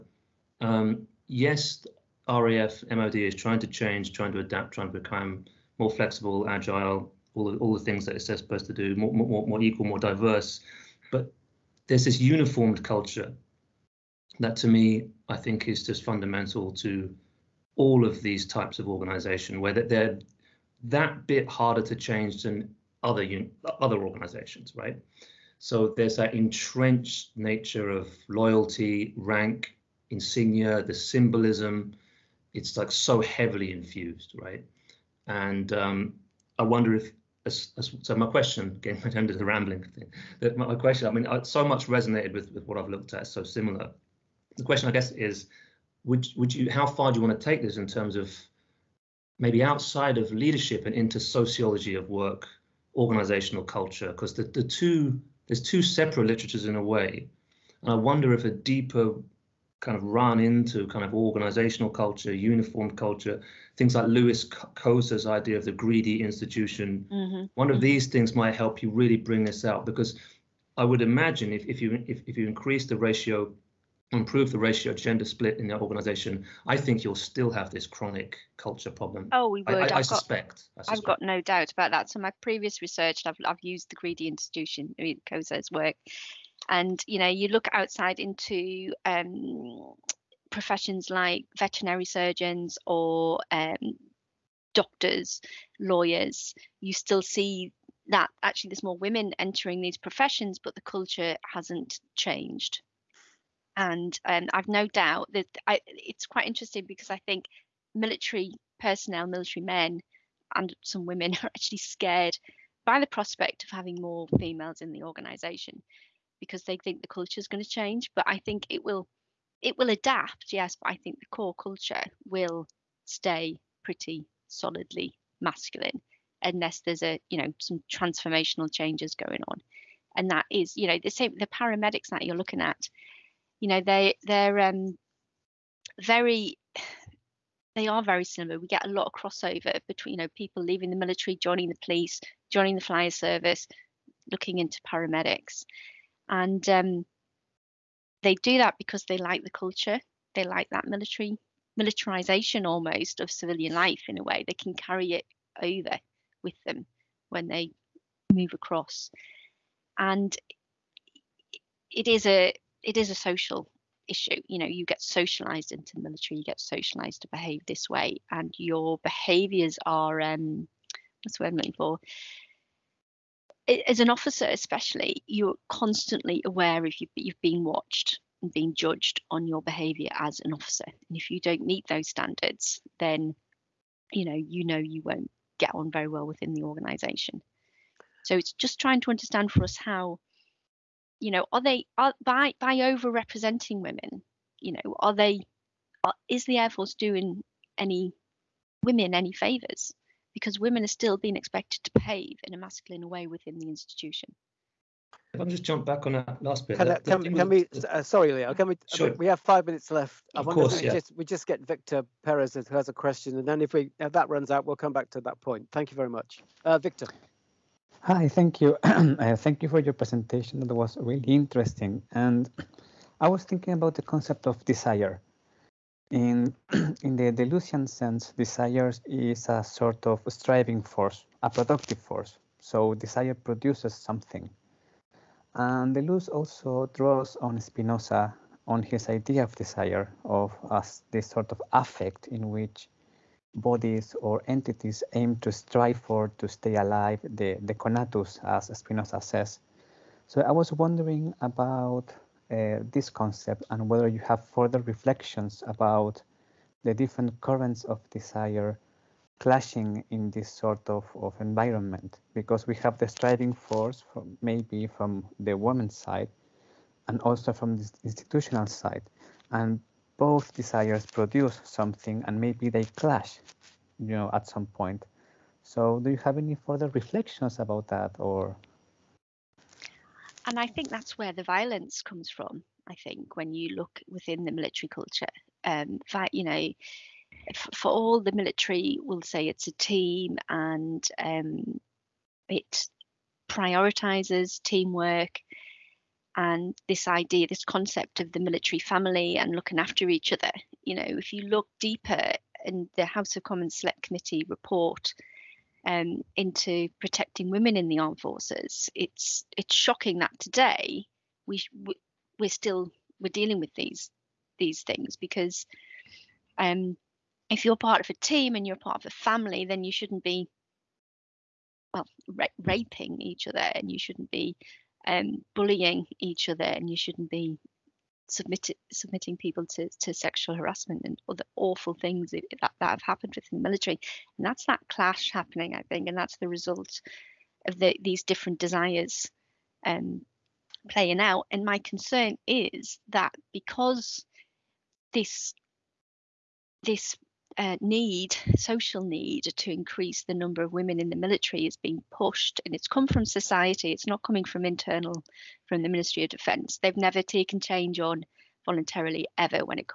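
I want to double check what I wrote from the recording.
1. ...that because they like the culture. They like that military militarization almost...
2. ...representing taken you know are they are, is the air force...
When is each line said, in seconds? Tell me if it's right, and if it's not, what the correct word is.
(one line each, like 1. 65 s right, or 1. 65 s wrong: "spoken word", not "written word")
1. 148 s right
2. 193 s wrong: "women", not "taken".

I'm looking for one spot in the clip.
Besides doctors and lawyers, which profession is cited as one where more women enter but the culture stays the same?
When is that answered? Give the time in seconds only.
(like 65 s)
91 s.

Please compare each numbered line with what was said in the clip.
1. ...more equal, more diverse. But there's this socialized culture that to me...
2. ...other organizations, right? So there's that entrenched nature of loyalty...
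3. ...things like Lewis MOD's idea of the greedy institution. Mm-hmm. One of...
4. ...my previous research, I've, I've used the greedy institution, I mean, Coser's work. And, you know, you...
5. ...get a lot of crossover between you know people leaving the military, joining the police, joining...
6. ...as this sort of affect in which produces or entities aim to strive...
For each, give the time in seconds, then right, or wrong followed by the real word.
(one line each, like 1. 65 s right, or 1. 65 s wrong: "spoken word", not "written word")
1. 9 s wrong: "uniformed", not "socialized"
2. 23 s right
3. 63 s wrong: "Coser", not "MOD"
4. 82 s right
5. 138 s right
6. 240 s wrong: "bodies", not "produces".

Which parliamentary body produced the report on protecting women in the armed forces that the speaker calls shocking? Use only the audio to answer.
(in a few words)
House of Commons Select Committee.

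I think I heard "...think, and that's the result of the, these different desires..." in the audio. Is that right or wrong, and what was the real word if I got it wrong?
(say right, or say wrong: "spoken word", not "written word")
right.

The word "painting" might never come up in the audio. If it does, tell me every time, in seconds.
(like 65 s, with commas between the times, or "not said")
not said.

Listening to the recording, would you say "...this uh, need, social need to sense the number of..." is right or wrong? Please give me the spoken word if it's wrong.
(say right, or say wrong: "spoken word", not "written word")
wrong: "increase", not "sense".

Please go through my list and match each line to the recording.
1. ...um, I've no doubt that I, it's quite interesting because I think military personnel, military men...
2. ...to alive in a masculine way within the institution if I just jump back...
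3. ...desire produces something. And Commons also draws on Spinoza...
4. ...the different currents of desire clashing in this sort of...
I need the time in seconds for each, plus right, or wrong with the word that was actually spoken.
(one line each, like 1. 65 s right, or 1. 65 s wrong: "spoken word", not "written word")
1. 104 s right
2. 201 s wrong: "behave", not "alive"
3. 232 s wrong: "Deleuze", not "Commons"
4. 256 s right.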